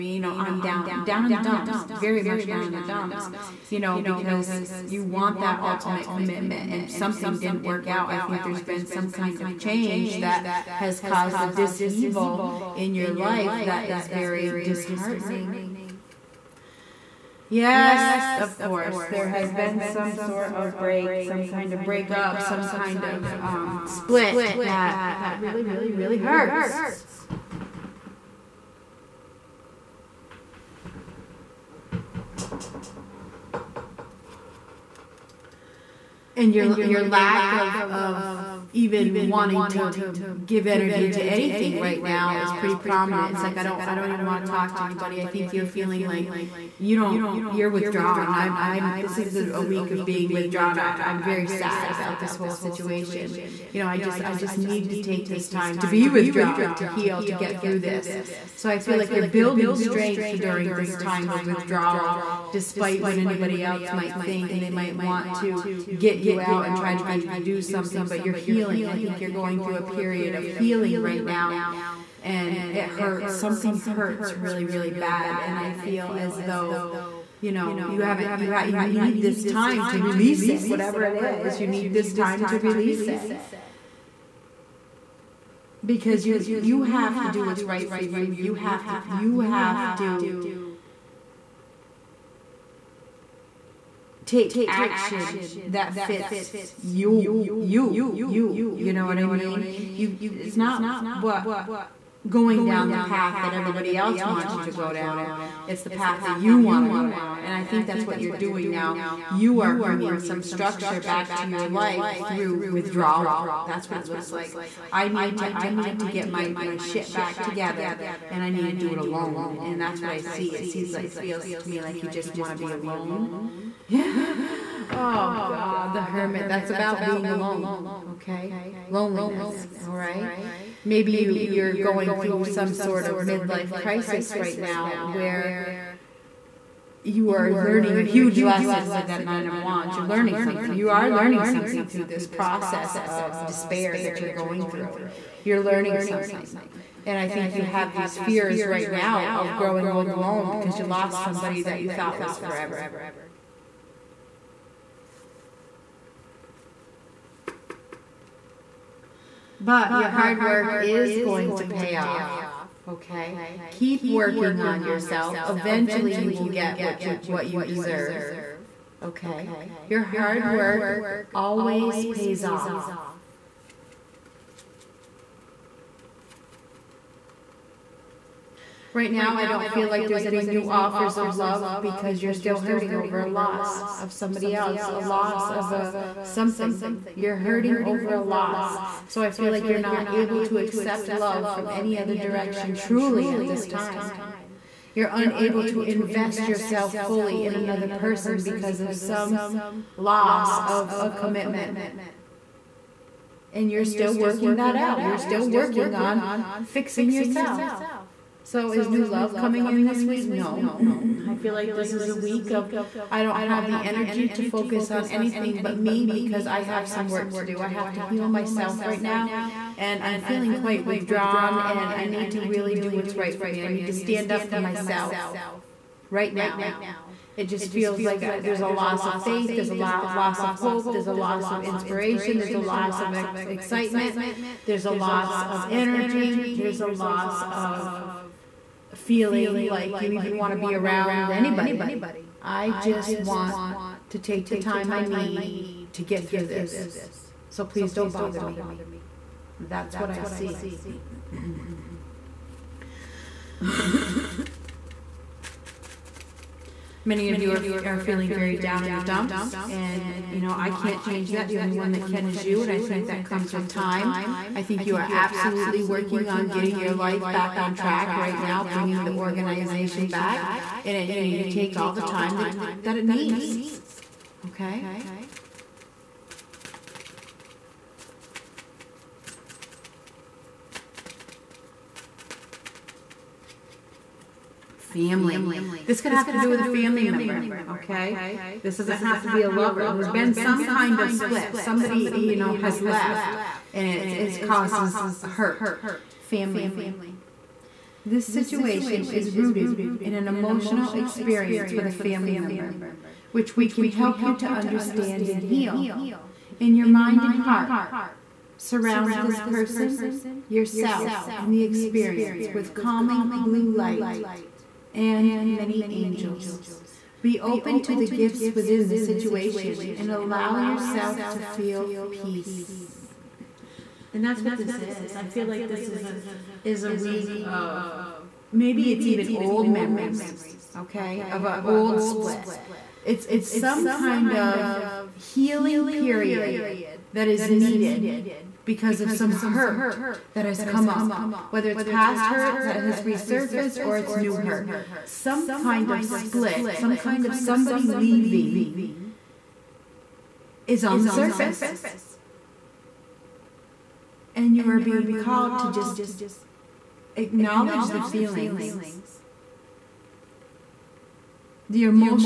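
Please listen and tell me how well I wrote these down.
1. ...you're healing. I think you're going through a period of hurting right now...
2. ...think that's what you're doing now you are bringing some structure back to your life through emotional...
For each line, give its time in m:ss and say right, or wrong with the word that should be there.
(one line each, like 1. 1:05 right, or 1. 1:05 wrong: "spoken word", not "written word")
1. 1:08 wrong: "healing", not "hurting"
2. 1:47 wrong: "withdrawal", not "emotional".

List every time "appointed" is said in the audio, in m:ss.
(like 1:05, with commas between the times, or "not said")
not said.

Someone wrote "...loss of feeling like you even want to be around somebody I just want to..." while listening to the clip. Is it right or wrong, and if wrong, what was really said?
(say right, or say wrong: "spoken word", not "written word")
wrong: "anybody", not "somebody".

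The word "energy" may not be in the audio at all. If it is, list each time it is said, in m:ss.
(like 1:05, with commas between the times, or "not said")
0:40, 3:33, 3:55.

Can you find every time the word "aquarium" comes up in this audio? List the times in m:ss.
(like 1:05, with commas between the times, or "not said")
not said.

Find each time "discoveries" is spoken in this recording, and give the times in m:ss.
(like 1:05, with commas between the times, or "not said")
not said.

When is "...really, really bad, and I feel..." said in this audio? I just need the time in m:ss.
1:14.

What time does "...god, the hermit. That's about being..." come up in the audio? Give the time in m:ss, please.
2:05.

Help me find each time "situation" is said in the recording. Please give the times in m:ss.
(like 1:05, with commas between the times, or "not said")
0:52, 4:58, 5:18.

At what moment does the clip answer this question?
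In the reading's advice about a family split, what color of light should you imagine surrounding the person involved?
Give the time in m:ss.
5:13.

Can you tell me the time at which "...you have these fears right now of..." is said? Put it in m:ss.
2:27.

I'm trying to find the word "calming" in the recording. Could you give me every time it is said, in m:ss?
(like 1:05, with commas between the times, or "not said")
5:12.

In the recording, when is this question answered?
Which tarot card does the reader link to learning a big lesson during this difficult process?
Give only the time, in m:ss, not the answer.
2:19.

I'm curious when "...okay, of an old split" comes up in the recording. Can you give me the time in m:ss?
5:30.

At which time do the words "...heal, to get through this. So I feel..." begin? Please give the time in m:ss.
0:56.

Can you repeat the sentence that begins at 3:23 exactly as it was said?
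And you're still working that out.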